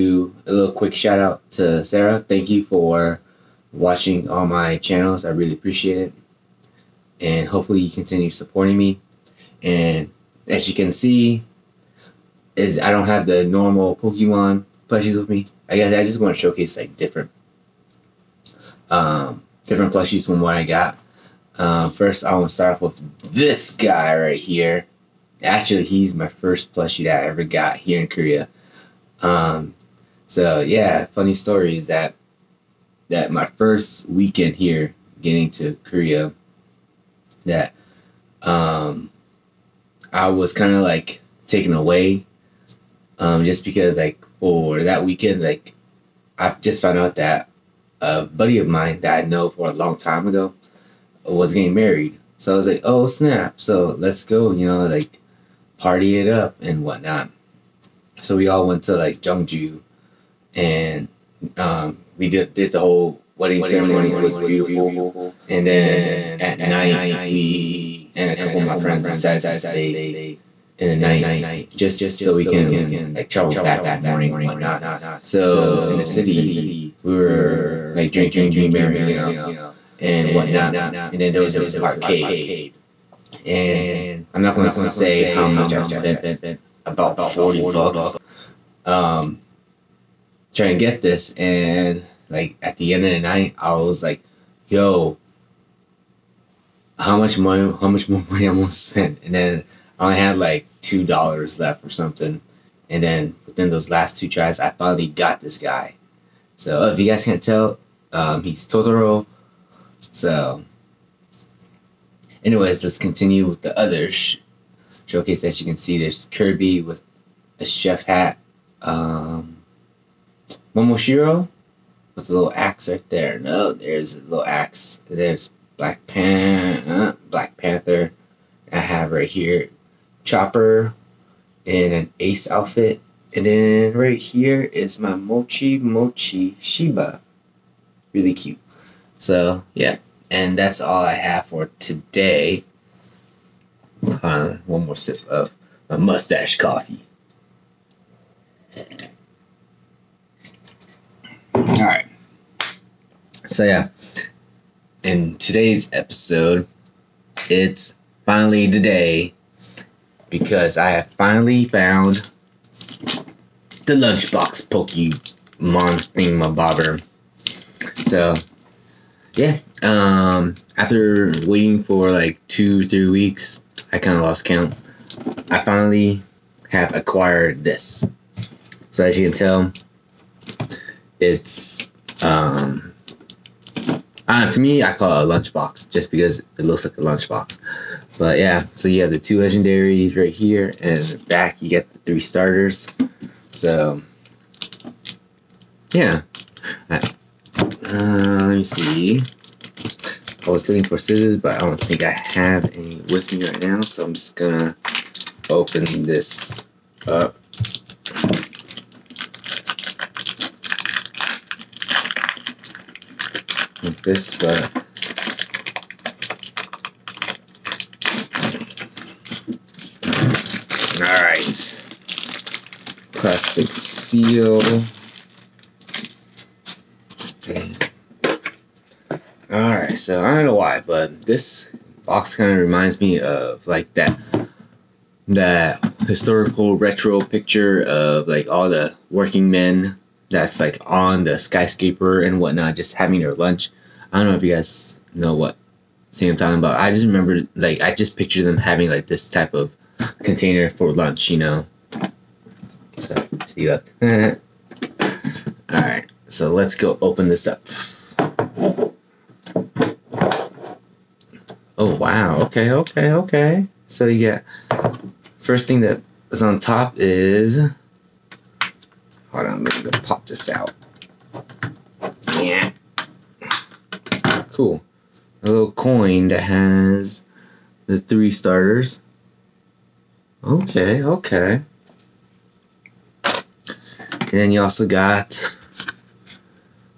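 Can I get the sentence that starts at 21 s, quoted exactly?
Um, first, I want to start off with this guy right here.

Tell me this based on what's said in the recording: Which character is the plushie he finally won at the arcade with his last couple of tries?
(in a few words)
Totoro.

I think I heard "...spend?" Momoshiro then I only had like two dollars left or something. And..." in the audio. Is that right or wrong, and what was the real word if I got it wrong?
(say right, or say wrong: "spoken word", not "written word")
wrong: "And", not "Momoshiro".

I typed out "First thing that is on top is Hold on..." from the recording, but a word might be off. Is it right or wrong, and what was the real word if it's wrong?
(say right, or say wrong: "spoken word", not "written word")
right.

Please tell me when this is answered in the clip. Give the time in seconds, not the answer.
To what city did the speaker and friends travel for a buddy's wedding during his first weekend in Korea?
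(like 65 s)
59 s.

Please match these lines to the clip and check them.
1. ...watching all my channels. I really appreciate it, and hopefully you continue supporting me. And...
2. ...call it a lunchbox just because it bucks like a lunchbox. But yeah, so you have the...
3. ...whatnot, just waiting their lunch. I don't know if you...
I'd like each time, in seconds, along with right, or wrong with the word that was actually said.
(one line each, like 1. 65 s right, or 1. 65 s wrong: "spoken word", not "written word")
1. 3 s right
2. 184 s wrong: "looks", not "bucks"
3. 242 s wrong: "having", not "waiting".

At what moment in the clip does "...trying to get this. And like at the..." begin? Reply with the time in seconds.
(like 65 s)
90 s.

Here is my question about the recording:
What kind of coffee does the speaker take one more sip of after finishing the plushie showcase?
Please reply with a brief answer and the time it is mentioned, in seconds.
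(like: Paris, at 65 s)
Mustache coffee, at 145 s.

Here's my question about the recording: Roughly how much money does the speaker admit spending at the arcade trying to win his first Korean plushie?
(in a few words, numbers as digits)
40 bucks.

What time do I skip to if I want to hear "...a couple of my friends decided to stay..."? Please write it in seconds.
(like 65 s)
68 s.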